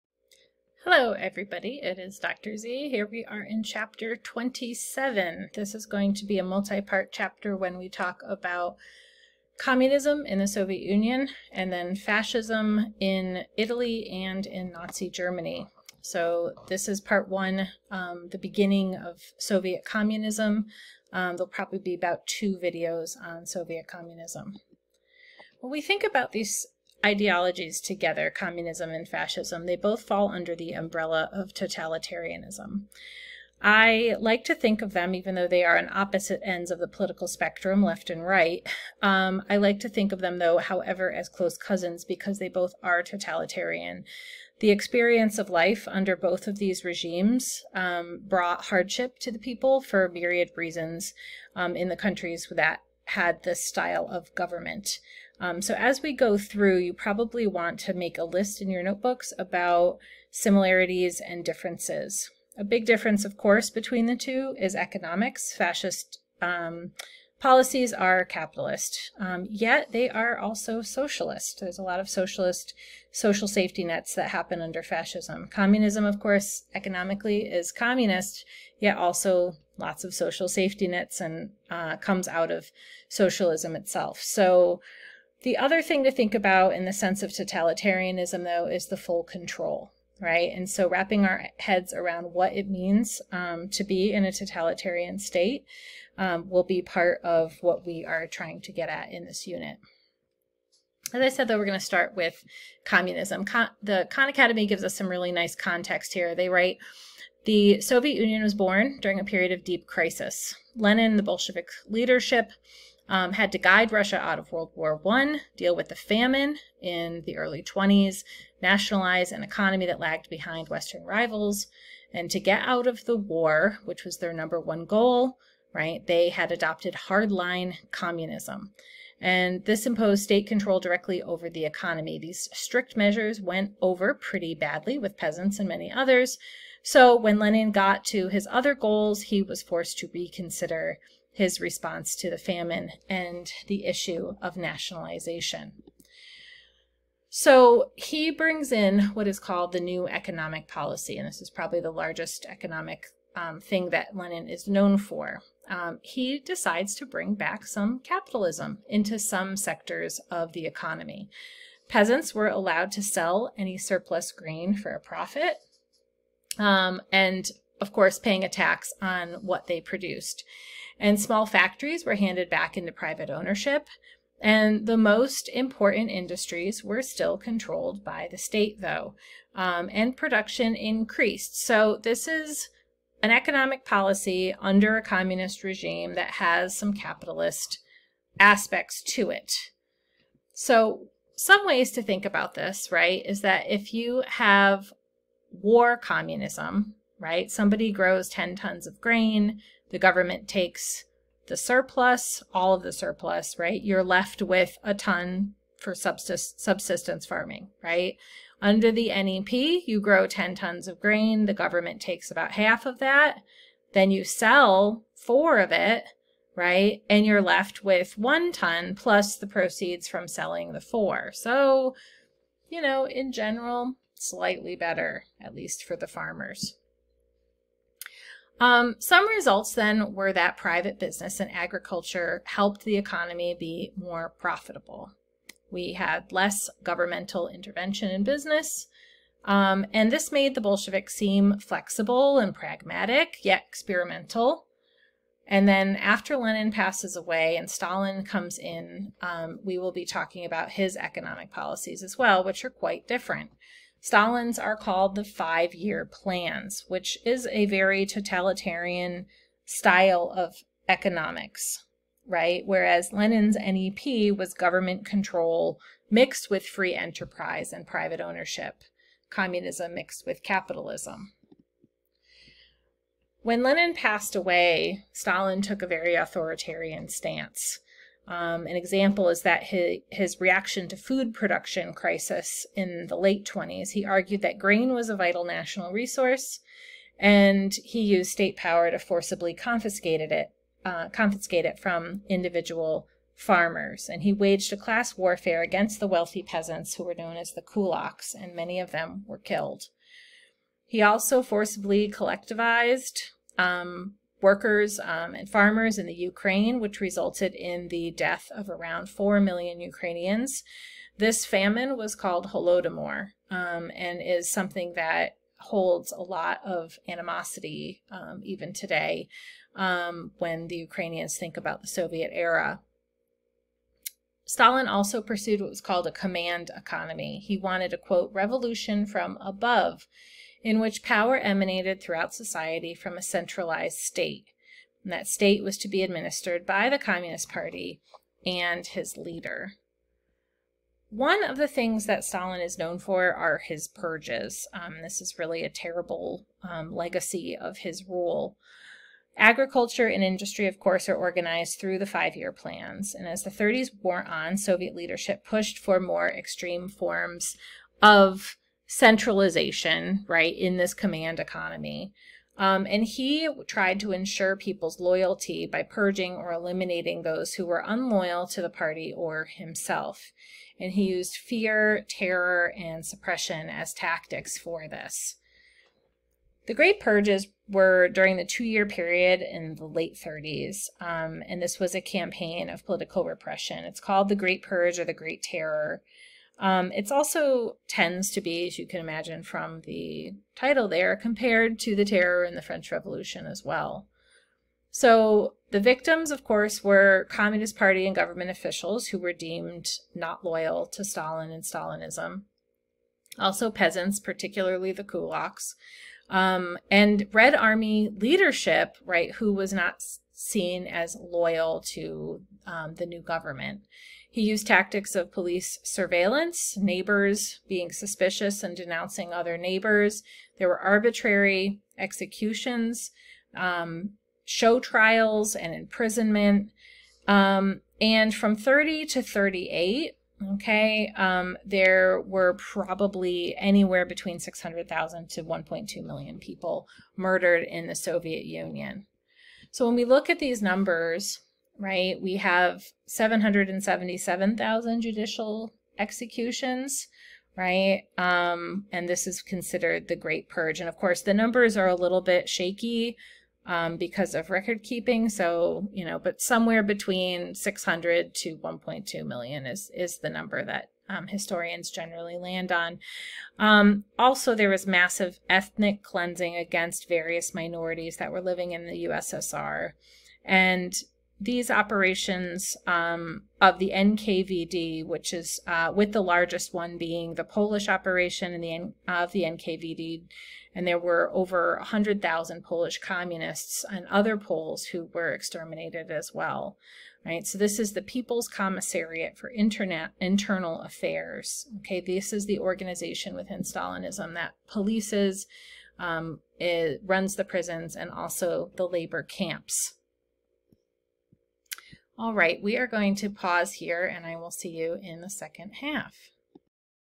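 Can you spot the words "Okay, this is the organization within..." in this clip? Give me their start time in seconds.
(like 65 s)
491 s.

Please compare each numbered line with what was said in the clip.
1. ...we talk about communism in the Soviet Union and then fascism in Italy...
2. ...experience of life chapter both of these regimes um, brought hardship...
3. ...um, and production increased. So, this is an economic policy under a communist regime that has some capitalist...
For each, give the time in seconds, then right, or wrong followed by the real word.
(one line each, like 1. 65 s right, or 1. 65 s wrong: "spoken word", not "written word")
1. 7 s right
2. 44 s wrong: "under", not "chapter"
3. 179 s right.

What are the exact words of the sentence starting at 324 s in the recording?
Stalin also pursued what was called a command economy.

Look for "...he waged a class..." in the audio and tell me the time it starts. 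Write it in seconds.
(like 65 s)
294 s.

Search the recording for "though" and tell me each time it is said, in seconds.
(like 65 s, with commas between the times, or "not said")
35 s, 40 s, 88 s, 101 s, 178 s.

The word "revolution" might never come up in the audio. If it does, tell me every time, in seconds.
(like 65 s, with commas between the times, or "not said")
328 s, 392 s.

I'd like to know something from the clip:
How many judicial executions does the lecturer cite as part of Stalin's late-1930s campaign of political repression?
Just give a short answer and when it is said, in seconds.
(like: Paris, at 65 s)
777,000, at 443 s.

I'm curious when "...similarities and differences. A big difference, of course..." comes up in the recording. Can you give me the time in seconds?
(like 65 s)
60 s.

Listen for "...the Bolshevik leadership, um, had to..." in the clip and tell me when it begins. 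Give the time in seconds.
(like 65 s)
111 s.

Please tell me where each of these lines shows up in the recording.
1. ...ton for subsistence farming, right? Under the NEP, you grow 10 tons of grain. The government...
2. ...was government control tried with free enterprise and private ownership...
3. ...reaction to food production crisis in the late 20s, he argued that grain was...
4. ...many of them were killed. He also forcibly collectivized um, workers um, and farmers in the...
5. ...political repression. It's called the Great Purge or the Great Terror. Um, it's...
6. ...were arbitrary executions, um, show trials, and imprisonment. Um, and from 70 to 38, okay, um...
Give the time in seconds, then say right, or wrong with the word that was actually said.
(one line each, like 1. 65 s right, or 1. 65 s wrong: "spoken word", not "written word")
1. 204 s right
2. 264 s wrong: "mixed", not "tried"
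3. 280 s right
4. 298 s right
5. 382 s right
6. 420 s wrong: "30", not "70".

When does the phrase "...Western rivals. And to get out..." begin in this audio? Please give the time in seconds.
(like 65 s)
120 s.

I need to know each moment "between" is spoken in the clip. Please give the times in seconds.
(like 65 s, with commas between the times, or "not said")
63 s, 434 s, 456 s.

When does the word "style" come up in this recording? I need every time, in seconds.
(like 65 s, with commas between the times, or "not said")
53 s, 259 s.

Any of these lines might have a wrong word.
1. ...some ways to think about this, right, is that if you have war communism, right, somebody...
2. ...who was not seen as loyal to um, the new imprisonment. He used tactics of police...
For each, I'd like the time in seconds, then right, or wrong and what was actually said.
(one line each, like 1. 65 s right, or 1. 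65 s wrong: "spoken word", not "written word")
1. 191 s right
2. 409 s wrong: "government", not "imprisonment".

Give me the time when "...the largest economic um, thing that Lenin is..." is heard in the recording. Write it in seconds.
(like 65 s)
151 s.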